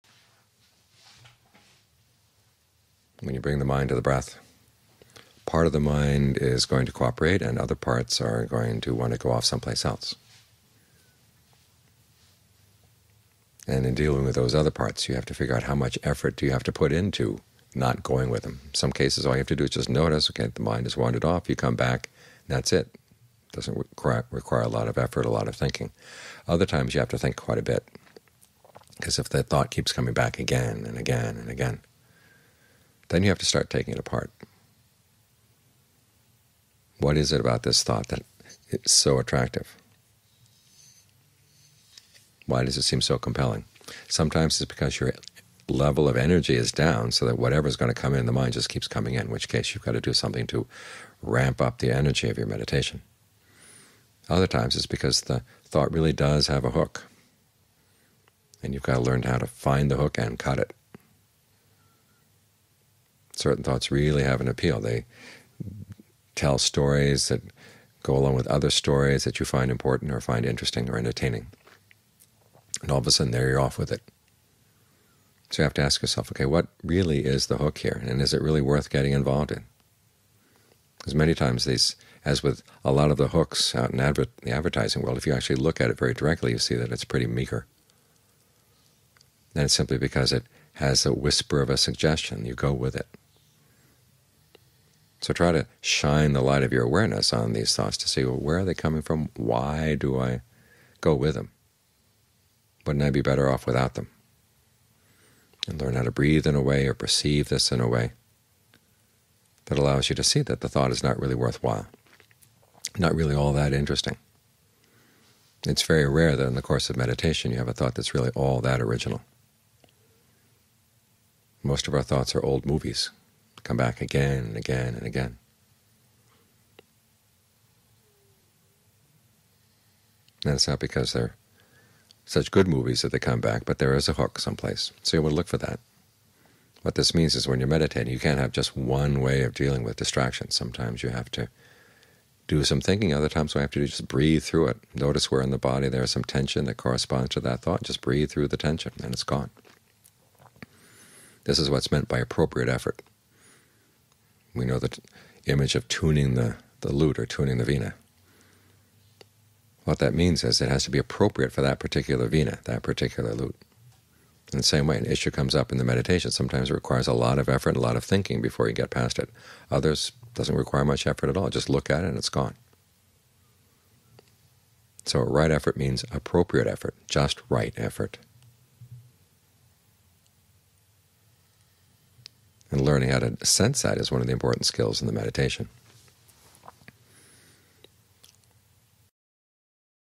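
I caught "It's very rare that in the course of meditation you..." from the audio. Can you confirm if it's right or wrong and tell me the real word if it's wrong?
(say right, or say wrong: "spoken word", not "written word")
right.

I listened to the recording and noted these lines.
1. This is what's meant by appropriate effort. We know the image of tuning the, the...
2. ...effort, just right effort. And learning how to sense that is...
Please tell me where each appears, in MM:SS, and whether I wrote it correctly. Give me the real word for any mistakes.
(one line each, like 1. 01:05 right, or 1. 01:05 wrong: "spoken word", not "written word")
1. 02:31 right
2. 02:56 right.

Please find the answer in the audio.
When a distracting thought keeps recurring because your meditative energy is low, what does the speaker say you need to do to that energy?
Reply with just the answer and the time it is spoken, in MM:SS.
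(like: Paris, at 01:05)
ramp up, at 00:51.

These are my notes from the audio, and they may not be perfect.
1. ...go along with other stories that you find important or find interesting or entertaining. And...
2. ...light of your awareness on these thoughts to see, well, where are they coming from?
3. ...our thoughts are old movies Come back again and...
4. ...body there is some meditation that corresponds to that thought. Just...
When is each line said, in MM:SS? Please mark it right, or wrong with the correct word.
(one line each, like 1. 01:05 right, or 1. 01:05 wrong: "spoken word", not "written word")
1. 01:08 right
2. 01:36 right
3. 02:01 right
4. 02:25 wrong: "tension", not "meditation".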